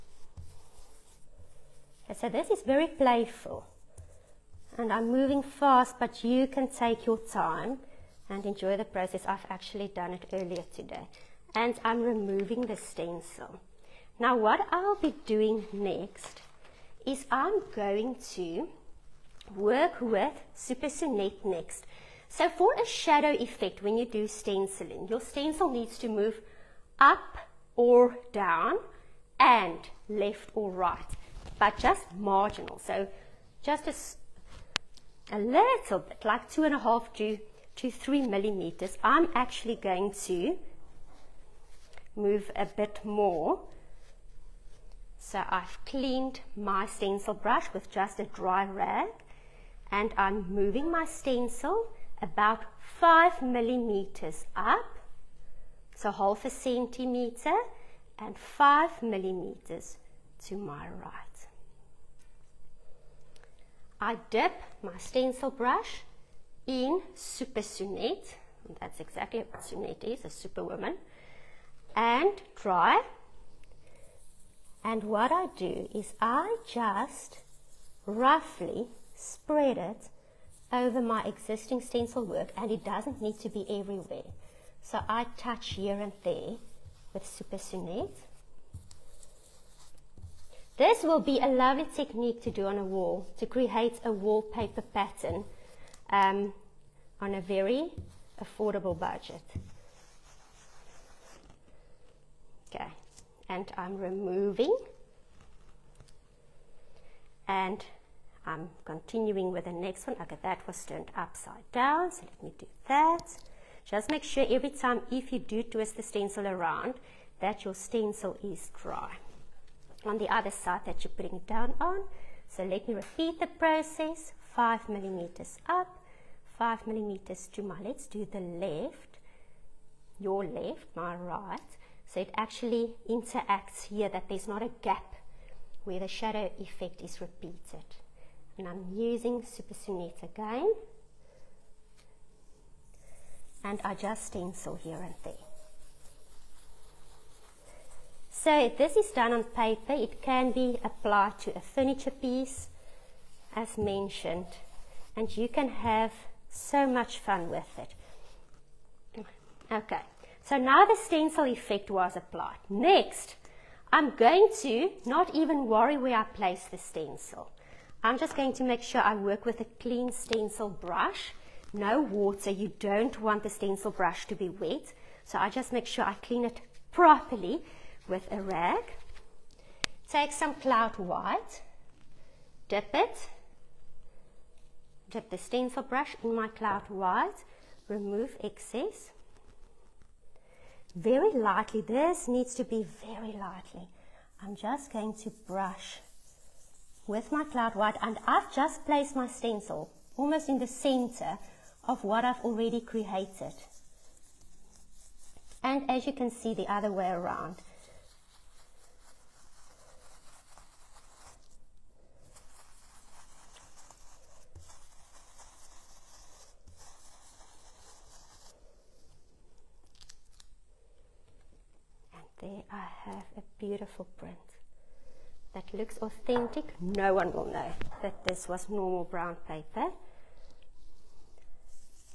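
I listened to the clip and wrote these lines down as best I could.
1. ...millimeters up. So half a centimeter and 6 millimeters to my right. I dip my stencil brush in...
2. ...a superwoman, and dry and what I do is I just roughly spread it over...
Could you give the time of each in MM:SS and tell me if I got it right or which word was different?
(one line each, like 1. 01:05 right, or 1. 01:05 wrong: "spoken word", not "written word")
1. 00:53 wrong: "5", not "6"
2. 01:10 right.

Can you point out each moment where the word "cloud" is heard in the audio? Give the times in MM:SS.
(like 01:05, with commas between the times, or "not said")
03:00, 03:06, 03:17.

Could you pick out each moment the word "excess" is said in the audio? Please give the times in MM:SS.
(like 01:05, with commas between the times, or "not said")
03:08.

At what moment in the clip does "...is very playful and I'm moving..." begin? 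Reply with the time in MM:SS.
00:02.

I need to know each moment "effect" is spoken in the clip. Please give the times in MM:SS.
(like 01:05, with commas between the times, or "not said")
00:23, 02:16, 02:41.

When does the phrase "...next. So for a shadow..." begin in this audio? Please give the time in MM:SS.
00:21.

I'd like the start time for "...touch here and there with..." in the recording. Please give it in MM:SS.
01:25.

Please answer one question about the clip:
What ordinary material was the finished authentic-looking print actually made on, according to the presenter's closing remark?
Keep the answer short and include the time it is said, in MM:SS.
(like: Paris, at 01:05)
Brown paper, at 03:49.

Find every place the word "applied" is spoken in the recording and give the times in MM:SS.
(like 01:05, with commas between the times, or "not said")
02:30, 02:42.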